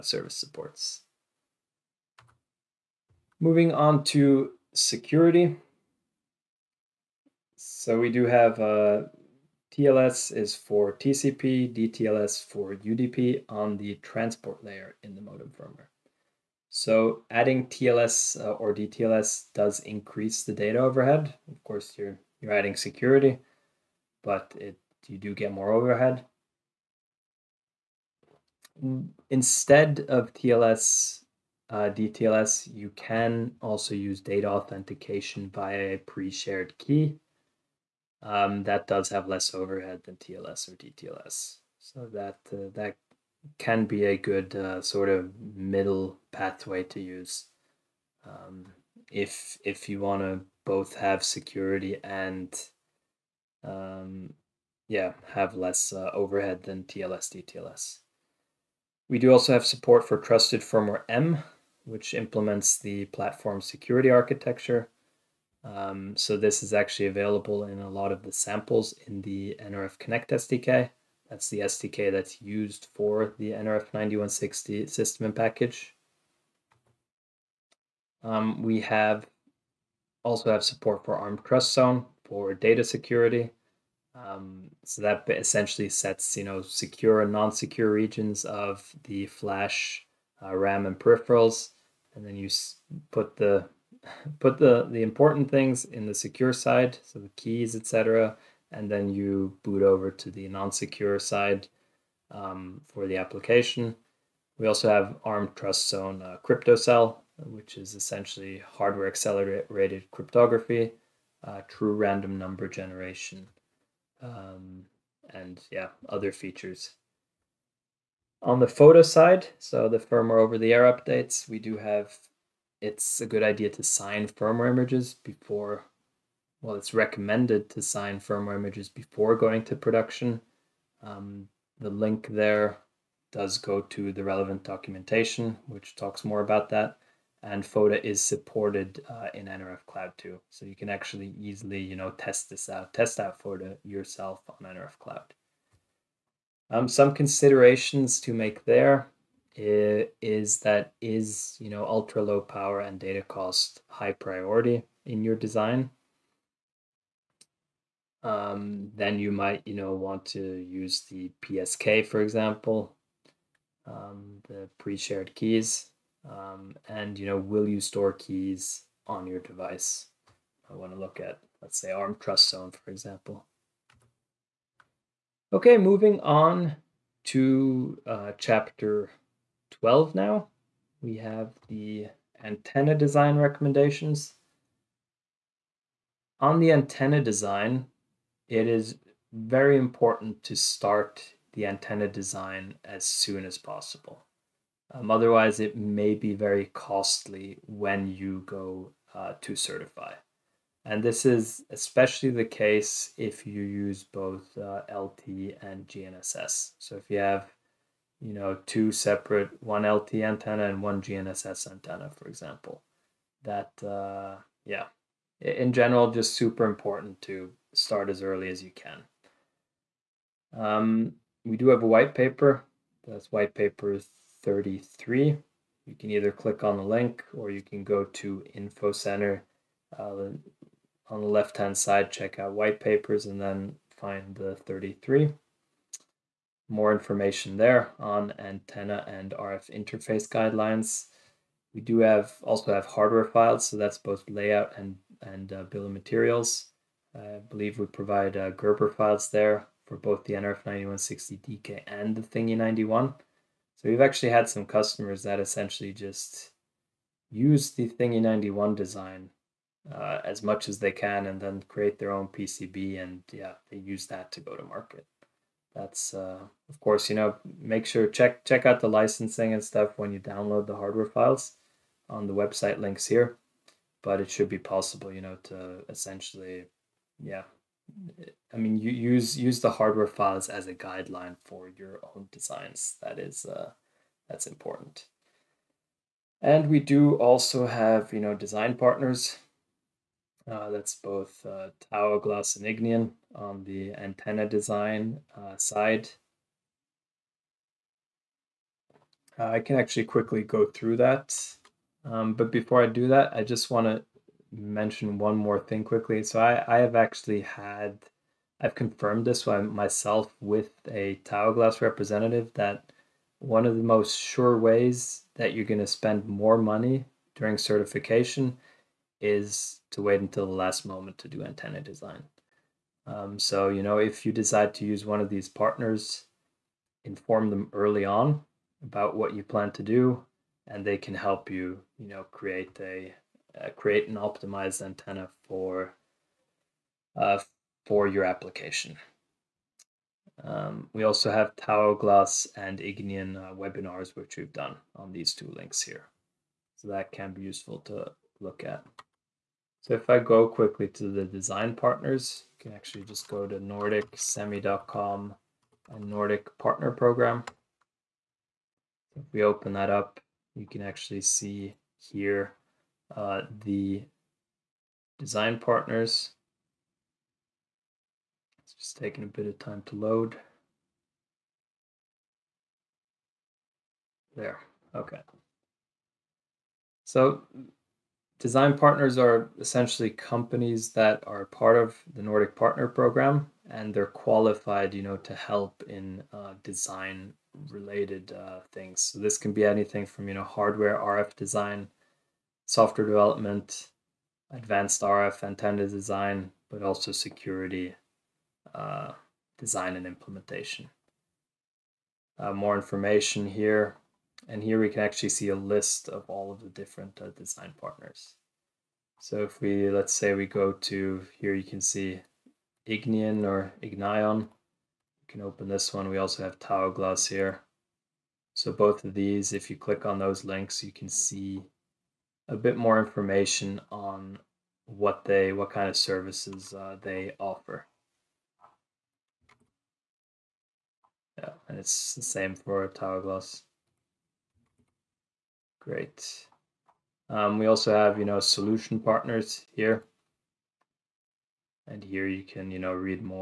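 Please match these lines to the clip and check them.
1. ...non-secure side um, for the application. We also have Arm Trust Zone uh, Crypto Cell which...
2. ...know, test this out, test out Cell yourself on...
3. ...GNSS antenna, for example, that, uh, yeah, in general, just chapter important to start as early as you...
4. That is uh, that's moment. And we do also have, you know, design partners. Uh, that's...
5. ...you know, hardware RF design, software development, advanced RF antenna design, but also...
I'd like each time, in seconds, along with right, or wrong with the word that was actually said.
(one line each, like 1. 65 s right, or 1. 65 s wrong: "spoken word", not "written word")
1. 100 s right
2. 141 s wrong: "FOTA", not "Cell"
3. 210 s wrong: "super", not "chapter"
4. 283 s wrong: "important", not "moment"
5. 390 s right.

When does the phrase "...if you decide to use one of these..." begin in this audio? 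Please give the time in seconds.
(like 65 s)
323 s.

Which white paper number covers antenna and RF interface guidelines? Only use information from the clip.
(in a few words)
33.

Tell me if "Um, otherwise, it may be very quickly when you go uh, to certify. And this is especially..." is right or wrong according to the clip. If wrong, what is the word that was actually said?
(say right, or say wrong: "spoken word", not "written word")
wrong: "costly", not "quickly".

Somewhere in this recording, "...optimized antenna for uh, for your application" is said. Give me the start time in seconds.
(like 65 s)
334 s.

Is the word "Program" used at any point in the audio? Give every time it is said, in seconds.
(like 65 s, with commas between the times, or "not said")
356 s, 382 s.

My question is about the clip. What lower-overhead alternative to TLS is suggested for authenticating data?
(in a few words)
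Pre-shared key.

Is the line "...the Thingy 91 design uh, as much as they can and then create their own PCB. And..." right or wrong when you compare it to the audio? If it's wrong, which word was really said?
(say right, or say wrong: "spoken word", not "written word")
right.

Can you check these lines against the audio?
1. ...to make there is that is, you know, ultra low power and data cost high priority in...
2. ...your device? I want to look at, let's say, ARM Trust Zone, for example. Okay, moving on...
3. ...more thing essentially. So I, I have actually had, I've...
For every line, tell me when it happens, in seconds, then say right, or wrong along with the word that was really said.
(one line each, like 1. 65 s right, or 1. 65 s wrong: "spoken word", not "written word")
1. 148 s right
2. 169 s right
3. 305 s wrong: "quickly", not "essentially".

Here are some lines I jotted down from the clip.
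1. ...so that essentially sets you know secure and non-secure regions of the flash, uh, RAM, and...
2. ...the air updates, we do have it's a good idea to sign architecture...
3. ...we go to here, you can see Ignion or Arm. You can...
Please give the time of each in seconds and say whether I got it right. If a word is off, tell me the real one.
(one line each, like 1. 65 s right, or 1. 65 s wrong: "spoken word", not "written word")
1. 84 s right
2. 120 s wrong: "firmware", not "architecture"
3. 410 s wrong: "Ignion", not "Arm".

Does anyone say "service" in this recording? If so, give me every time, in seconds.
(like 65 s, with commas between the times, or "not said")
0 s, 425 s.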